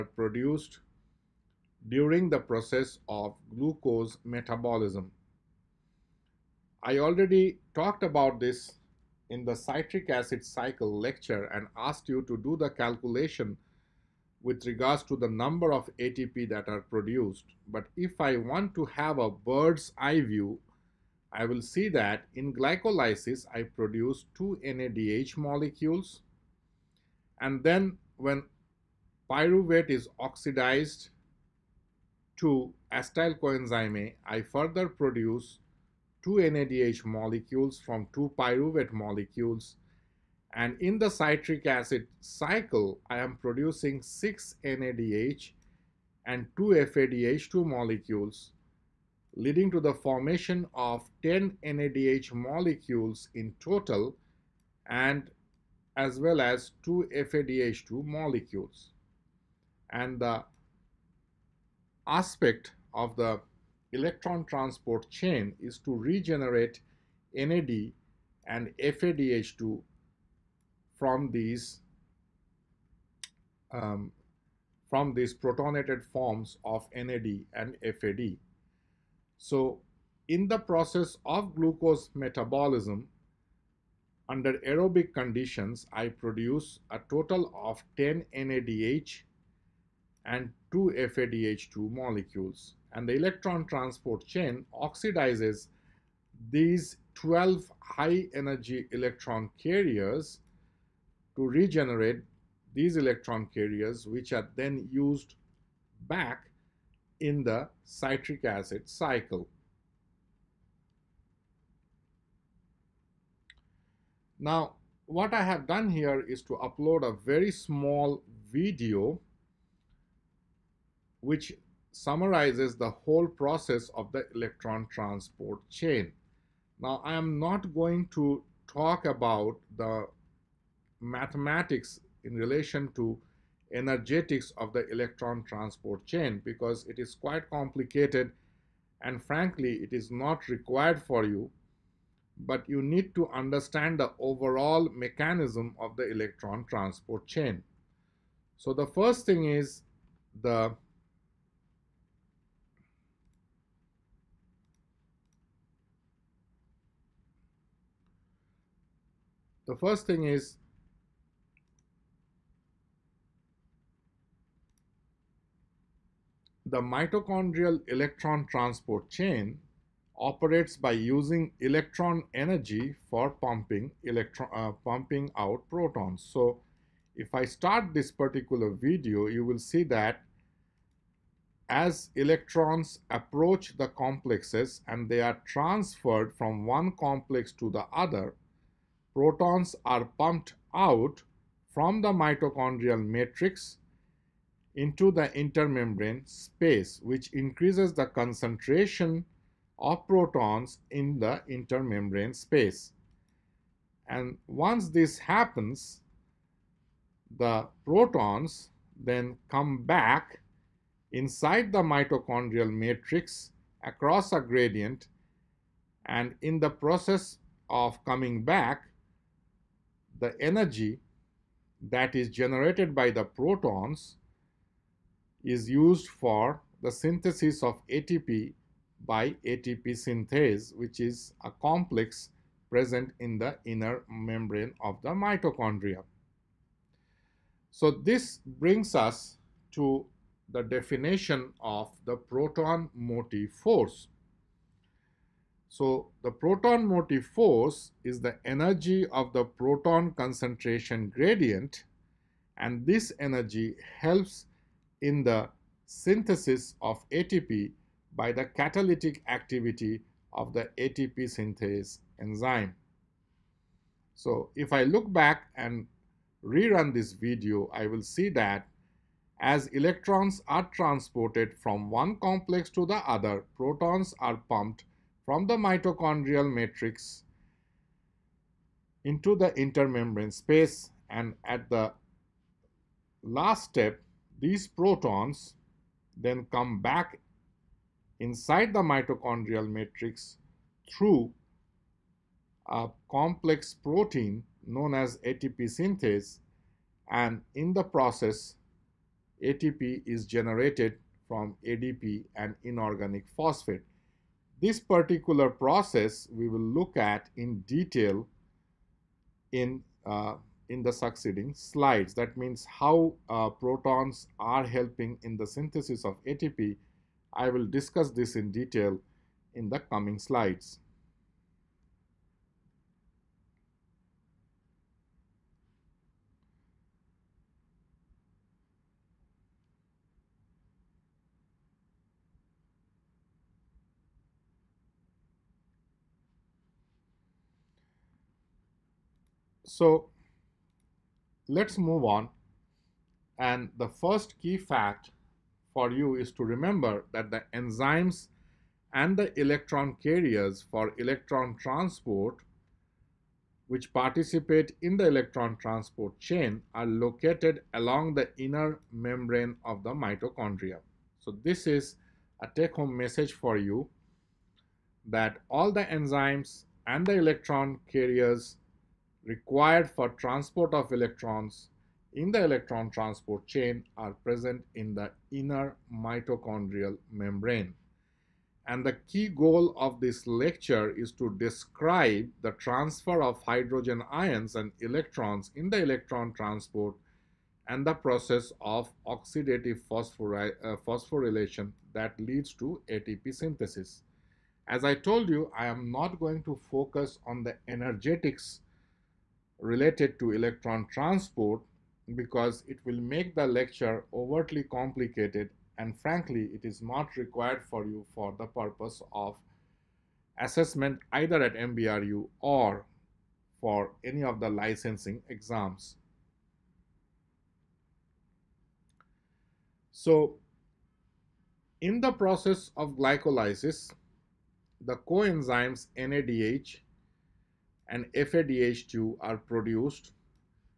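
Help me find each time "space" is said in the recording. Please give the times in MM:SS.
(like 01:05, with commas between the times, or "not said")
03:16, 03:22, 04:40.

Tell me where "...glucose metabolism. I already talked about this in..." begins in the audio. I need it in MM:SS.
00:03.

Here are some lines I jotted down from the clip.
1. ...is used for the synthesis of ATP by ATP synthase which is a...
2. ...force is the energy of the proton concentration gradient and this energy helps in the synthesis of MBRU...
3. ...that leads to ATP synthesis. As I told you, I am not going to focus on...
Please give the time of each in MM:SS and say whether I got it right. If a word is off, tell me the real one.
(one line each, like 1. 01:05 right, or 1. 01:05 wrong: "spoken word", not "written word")
1. 03:45 right
2. 04:07 wrong: "ATP", not "MBRU"
3. 06:31 right.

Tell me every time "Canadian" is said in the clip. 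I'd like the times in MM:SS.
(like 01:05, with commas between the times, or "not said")
not said.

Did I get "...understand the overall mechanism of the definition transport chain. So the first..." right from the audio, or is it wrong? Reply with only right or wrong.
wrong.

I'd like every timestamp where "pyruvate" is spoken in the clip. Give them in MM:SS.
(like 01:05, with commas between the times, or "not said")
00:29, 00:38.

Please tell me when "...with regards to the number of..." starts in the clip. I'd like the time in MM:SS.
00:14.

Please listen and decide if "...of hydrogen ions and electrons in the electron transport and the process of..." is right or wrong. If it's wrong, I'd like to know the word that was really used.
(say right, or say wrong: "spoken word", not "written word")
right.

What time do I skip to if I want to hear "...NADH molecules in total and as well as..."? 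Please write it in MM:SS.
00:51.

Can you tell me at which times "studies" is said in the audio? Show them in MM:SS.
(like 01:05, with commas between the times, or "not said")
not said.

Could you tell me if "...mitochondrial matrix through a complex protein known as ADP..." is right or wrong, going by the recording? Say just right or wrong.
wrong.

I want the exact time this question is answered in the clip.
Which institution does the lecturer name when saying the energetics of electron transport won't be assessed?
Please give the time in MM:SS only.
06:51.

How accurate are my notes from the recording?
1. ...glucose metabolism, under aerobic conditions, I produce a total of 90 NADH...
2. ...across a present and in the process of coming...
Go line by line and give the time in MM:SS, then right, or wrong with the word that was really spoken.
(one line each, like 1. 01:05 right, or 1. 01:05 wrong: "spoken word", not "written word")
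1. 01:21 wrong: "10", not "90"
2. 03:33 wrong: "gradient", not "present".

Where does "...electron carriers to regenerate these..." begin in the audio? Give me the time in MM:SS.
01:38.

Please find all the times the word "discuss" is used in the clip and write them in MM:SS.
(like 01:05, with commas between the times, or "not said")
05:17.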